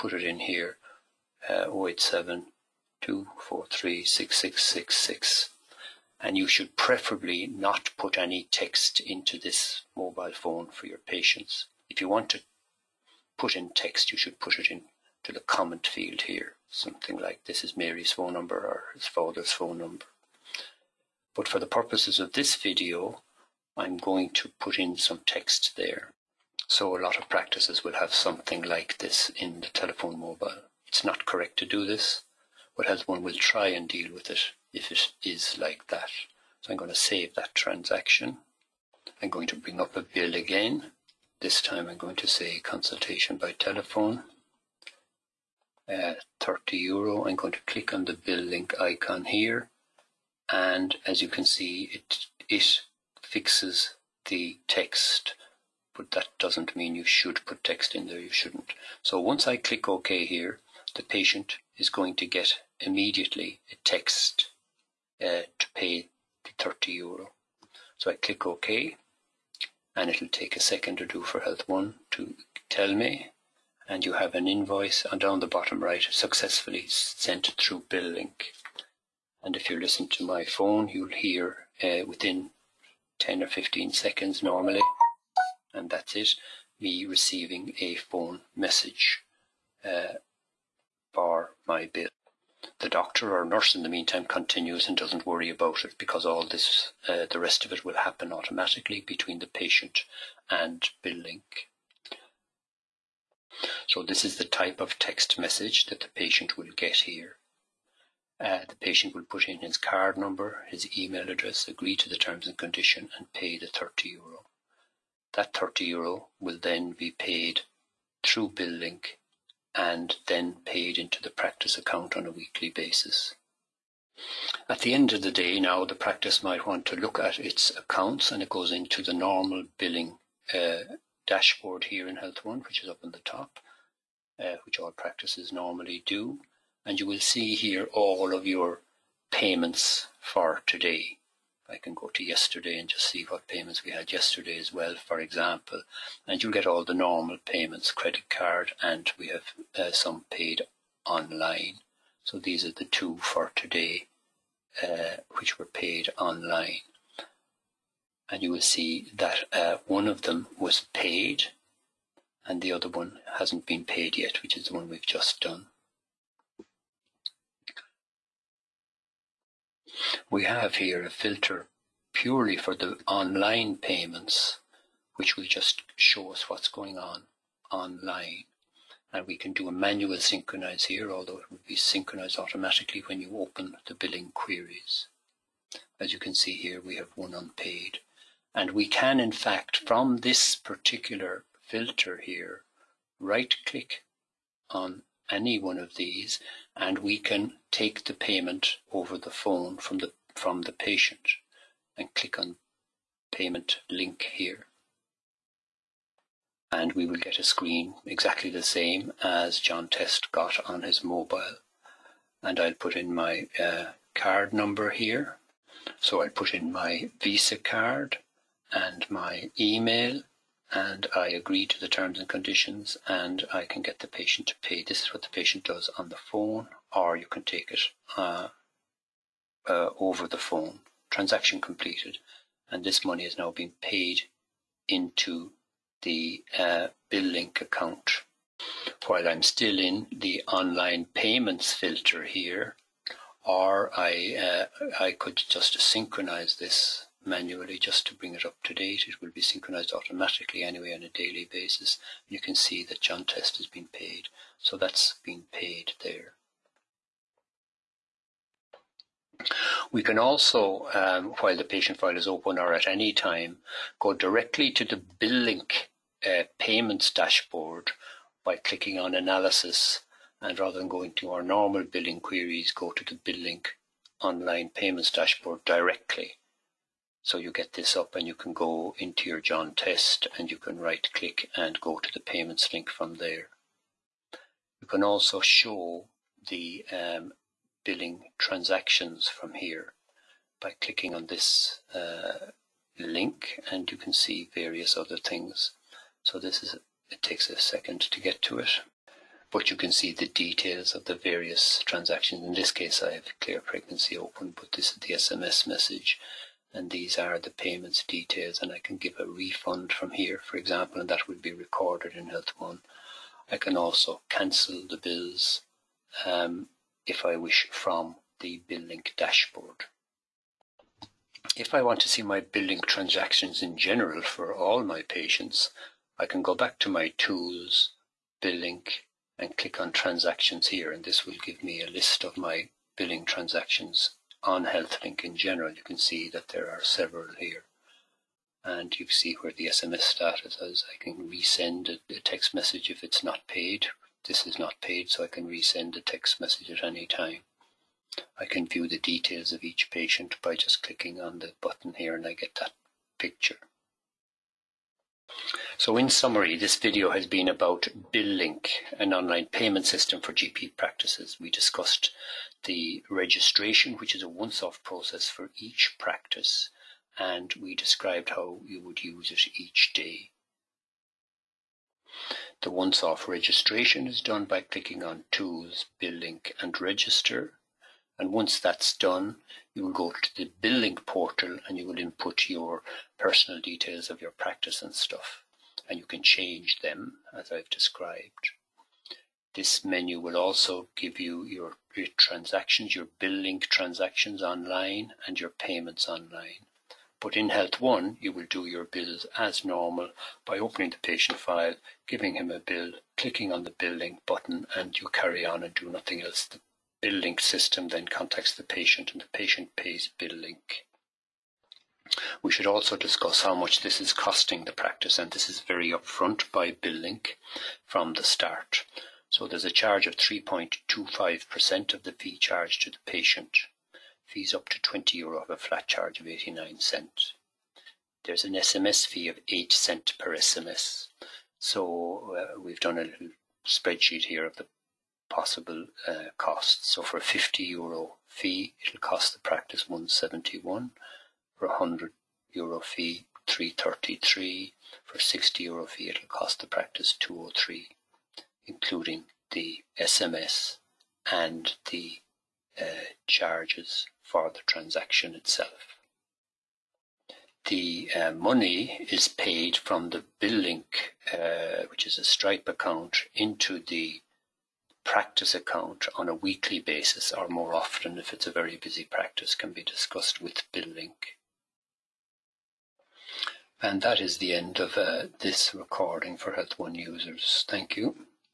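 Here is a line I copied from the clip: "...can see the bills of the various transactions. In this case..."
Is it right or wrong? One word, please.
wrong.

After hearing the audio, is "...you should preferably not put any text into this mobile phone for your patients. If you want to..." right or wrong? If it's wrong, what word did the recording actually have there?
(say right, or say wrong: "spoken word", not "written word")
right.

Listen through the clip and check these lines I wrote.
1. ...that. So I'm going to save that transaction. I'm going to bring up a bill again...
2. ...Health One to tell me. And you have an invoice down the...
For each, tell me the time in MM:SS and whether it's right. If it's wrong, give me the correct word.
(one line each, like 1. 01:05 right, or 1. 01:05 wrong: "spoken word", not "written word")
1. 00:35 right
2. 01:11 right.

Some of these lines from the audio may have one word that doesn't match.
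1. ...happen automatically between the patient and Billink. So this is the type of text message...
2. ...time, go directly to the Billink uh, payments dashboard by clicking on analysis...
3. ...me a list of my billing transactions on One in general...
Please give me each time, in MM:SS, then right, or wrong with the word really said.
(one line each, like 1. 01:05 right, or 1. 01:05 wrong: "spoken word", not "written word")
1. 01:37 right
2. 04:23 right
3. 05:31 wrong: "HealthLink", not "One".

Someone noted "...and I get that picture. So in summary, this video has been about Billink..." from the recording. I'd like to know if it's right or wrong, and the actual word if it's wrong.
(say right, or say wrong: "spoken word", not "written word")
right.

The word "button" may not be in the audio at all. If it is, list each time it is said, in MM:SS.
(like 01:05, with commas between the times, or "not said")
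05:51, 06:44.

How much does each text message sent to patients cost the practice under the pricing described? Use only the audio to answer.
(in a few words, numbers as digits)
8 cent.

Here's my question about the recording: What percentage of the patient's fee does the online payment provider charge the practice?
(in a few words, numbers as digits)
3.25%.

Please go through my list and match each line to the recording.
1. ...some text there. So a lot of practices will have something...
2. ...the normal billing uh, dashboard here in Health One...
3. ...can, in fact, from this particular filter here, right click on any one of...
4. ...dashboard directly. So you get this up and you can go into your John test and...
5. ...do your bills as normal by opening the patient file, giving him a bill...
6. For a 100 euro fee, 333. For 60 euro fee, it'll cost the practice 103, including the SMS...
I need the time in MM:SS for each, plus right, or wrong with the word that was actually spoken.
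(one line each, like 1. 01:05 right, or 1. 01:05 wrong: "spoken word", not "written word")
1. 00:24 right
2. 02:09 right
3. 03:08 right
4. 04:35 right
5. 06:38 right
6. 07:21 wrong: "203", not "103".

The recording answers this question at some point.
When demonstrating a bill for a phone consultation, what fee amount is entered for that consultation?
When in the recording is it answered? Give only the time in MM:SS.
00:46.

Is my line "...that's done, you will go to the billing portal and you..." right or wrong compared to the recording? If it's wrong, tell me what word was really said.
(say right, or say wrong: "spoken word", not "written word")
right.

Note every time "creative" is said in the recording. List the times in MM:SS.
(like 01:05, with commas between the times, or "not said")
not said.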